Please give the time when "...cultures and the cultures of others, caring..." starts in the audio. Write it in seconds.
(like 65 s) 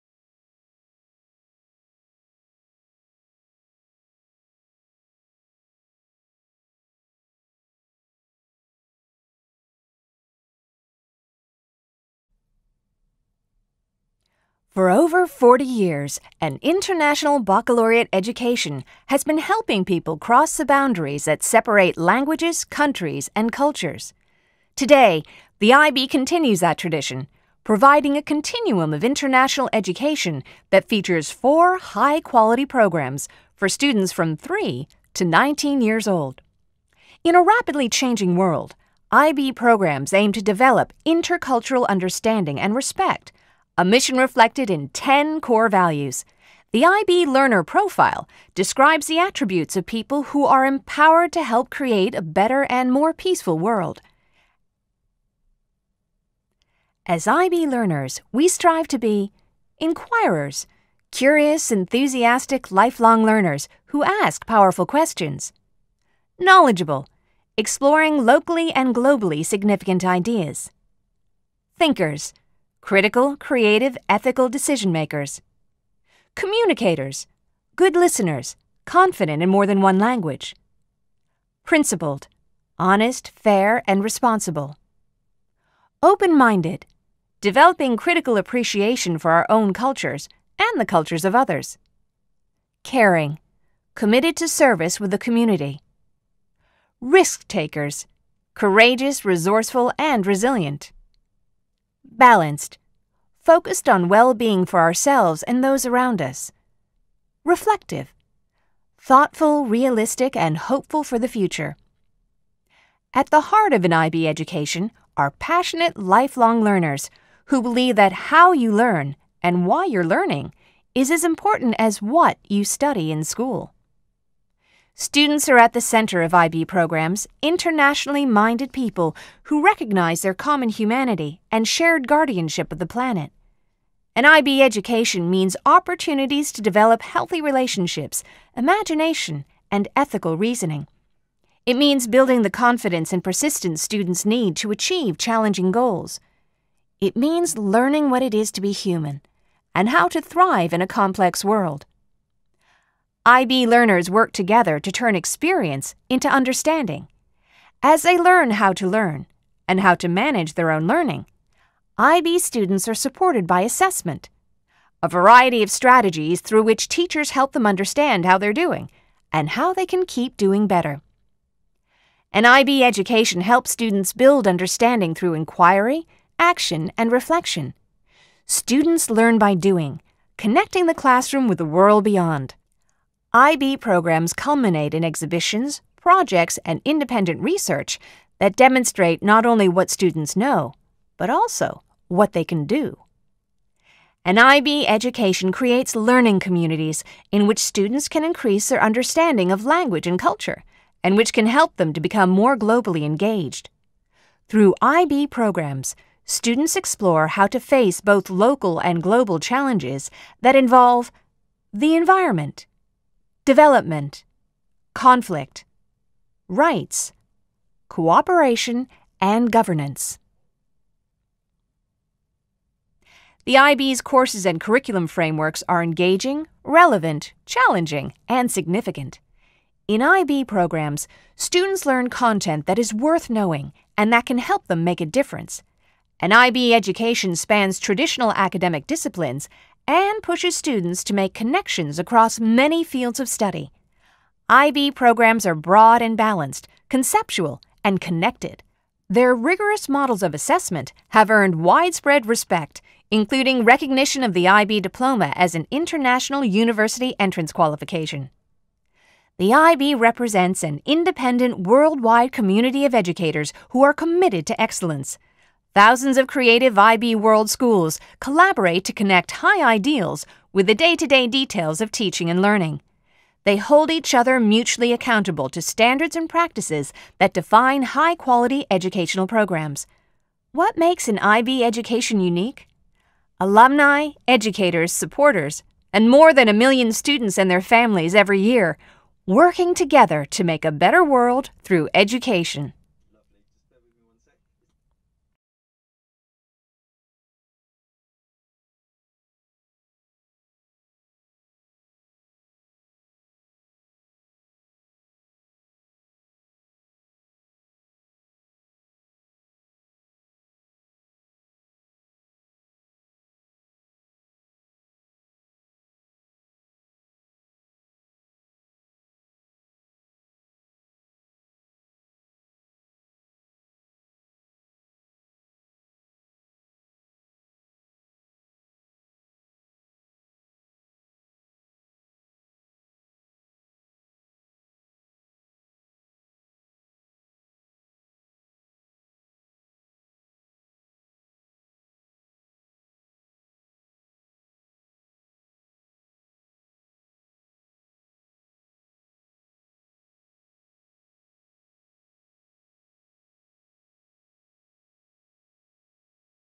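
89 s.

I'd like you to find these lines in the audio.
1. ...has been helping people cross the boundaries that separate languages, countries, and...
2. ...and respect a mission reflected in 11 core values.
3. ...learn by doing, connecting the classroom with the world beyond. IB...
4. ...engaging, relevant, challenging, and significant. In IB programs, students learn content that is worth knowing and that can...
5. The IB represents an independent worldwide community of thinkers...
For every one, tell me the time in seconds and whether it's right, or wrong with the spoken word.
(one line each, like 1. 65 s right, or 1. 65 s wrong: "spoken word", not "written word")
1. 19 s right
2. 42 s wrong: "10", not "11"
3. 179 s right
4. 225 s right
5. 259 s wrong: "educators", not "thinkers".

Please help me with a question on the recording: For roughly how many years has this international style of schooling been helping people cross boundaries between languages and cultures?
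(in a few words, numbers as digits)
40.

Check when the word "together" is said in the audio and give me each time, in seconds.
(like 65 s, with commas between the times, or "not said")
154 s, 289 s.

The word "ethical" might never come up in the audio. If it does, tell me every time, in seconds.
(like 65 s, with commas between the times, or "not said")
74 s, 139 s.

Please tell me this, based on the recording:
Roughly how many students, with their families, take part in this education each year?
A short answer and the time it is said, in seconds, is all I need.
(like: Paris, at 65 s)
more than a million, at 286 s.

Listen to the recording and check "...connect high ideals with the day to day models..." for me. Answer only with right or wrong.
wrong.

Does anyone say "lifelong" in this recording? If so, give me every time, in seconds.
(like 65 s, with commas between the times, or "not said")
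62 s, 115 s.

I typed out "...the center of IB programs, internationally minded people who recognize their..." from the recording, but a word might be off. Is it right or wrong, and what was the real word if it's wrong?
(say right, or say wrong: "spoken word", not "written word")
right.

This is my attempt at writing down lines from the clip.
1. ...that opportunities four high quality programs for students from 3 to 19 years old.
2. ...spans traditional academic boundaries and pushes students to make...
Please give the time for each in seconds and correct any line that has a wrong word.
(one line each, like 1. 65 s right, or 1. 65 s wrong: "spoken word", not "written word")
1. 30 s wrong: "features", not "opportunities"
2. 237 s wrong: "disciplines", not "boundaries".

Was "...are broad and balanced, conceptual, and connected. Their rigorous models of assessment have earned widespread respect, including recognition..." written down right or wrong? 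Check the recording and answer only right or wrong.
right.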